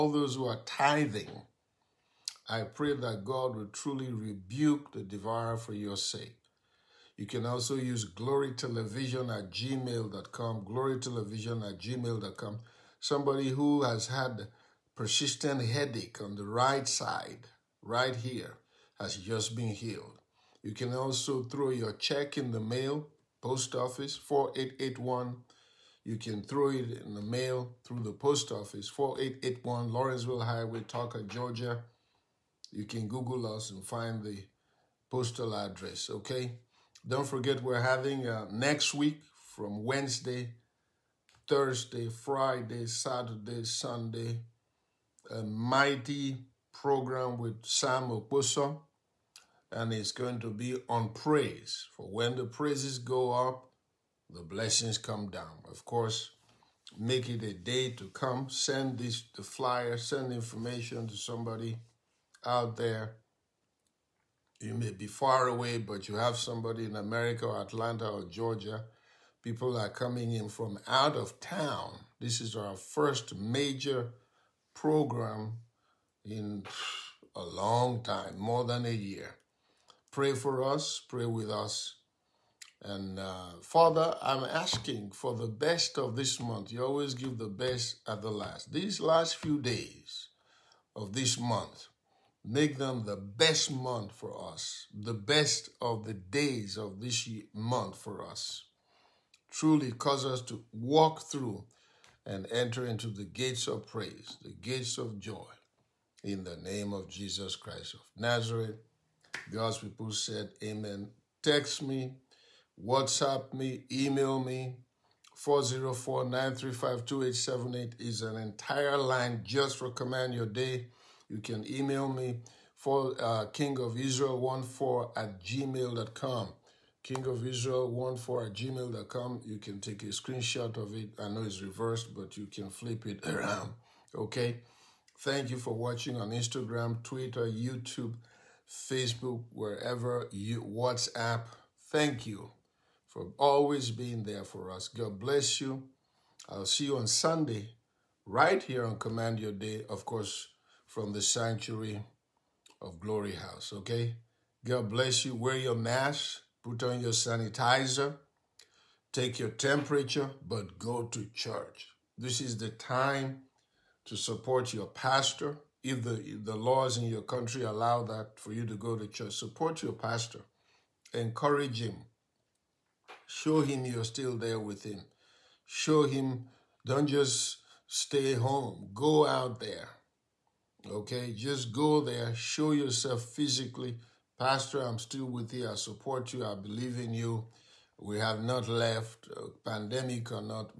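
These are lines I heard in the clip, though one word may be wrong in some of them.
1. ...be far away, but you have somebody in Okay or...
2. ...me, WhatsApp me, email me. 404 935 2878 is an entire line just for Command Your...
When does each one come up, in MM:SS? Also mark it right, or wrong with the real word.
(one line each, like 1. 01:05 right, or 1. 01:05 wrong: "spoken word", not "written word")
1. 01:04 wrong: "America", not "Okay"
2. 01:51 right.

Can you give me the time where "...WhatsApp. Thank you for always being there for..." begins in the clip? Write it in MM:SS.
02:20.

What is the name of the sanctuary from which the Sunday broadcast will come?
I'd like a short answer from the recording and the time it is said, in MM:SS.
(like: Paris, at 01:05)
Glory House, at 02:32.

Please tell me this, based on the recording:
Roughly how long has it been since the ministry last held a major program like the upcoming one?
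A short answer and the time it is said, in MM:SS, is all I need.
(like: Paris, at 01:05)
More than a year, at 01:18.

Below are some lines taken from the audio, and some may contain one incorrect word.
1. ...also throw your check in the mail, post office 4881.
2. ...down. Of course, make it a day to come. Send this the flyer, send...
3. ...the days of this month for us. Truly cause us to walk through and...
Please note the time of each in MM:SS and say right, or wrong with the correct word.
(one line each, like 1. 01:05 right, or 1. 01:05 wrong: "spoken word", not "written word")
1. 00:20 right
2. 00:55 right
3. 01:36 right.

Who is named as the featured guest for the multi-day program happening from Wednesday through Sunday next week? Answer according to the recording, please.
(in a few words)
Sam Oposo.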